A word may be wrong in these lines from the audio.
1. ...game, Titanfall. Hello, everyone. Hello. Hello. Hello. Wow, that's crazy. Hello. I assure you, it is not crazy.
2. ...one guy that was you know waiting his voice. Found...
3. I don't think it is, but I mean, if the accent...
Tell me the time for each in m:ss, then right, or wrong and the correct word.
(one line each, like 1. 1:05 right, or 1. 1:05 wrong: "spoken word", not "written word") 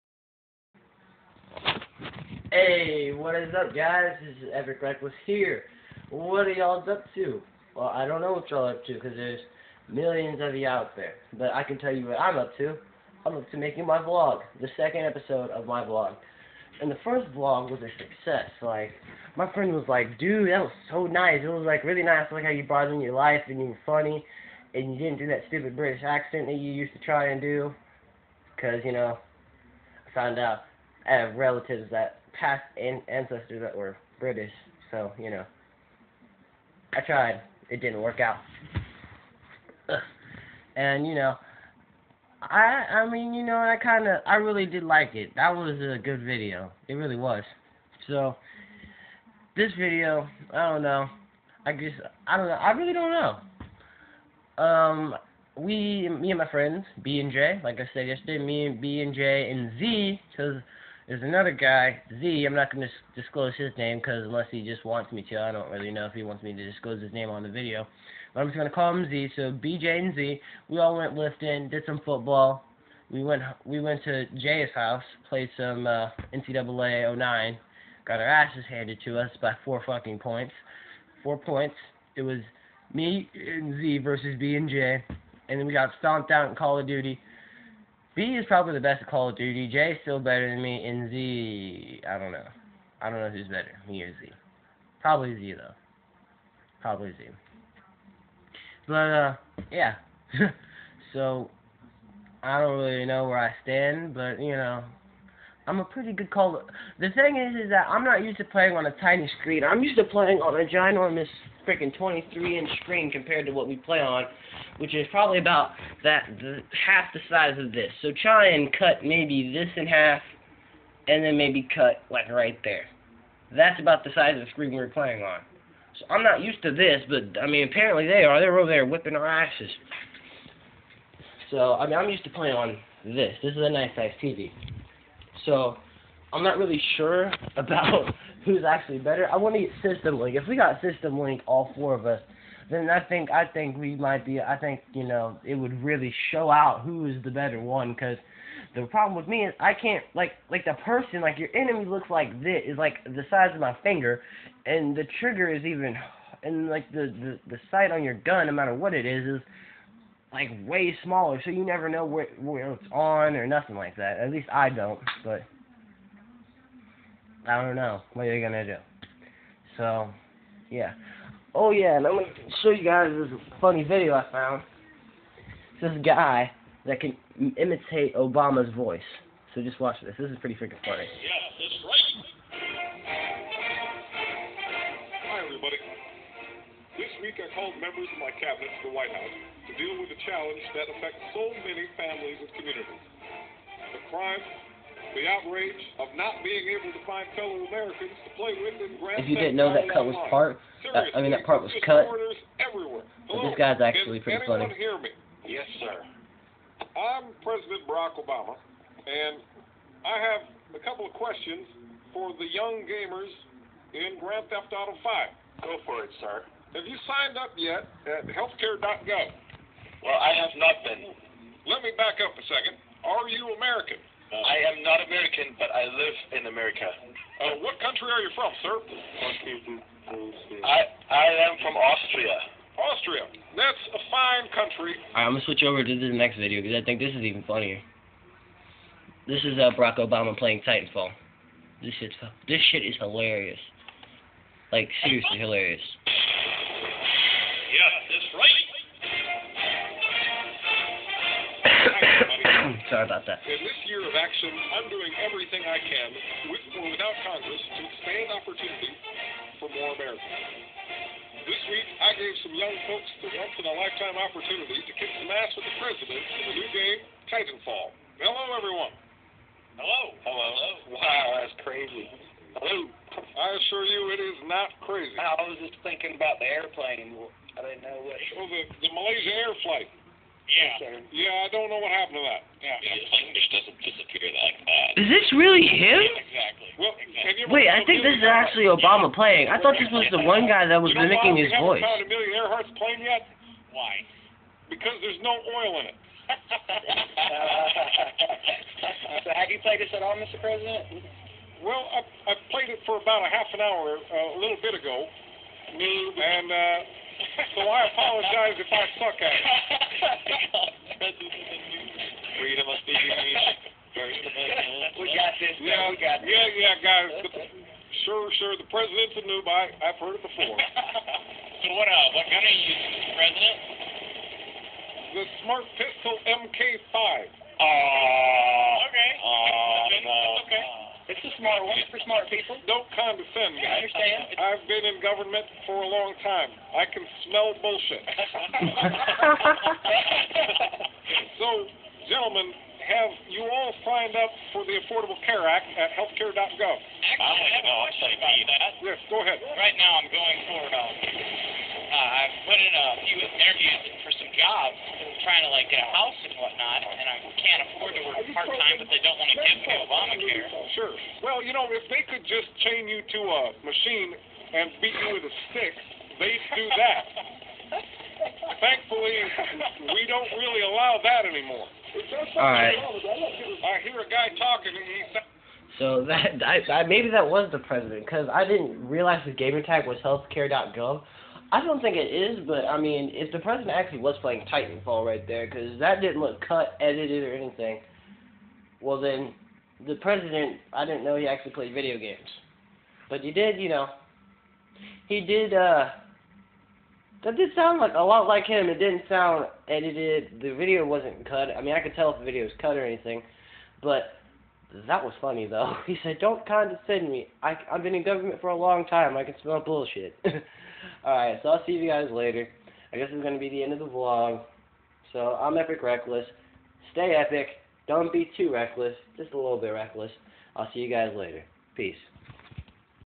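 1. 4:26 right
2. 4:50 wrong: "mimicking", not "waiting"
3. 6:21 wrong: "president", not "accent".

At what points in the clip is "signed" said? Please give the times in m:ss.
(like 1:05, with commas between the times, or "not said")
3:37, 5:43.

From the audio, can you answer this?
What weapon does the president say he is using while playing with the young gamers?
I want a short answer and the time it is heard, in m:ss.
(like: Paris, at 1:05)
Smart Pistol MK5, at 5:25.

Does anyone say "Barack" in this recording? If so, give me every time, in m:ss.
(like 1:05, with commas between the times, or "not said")
3:27, 3:59.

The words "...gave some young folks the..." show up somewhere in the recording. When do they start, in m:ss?
4:22.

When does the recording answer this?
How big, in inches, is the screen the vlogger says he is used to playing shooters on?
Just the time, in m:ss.
1:51.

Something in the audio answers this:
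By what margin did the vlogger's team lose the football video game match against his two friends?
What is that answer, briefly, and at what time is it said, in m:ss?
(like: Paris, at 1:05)
4 points, at 1:19.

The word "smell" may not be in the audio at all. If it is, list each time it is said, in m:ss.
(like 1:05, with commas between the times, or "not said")
5:37, 6:49.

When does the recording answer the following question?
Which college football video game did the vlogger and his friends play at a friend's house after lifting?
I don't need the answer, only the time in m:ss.
1:16.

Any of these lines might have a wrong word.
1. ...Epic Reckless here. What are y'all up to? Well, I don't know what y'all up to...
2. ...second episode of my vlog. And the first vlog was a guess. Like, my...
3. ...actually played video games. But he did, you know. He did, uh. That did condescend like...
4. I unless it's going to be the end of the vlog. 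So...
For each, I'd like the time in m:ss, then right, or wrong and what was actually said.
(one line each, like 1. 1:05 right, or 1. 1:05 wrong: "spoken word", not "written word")
1. 0:04 right
2. 0:14 wrong: "success", not "guess"
3. 6:31 wrong: "sound", not "condescend"
4. 6:52 wrong: "guess", not "unless".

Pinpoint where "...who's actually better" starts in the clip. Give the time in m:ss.
2:18.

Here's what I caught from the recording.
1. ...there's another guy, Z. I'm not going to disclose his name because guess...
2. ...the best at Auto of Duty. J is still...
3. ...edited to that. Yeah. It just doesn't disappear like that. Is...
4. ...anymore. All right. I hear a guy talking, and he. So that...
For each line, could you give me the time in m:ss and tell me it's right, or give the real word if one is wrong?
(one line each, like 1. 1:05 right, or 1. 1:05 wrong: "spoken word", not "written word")
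1. 1:01 wrong: "unless", not "guess"
2. 1:28 wrong: "Call", not "Auto"
3. 4:41 wrong: "happened", not "edited"
4. 6:11 right.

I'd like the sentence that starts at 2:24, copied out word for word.
I think you know it would really show out who is the better one.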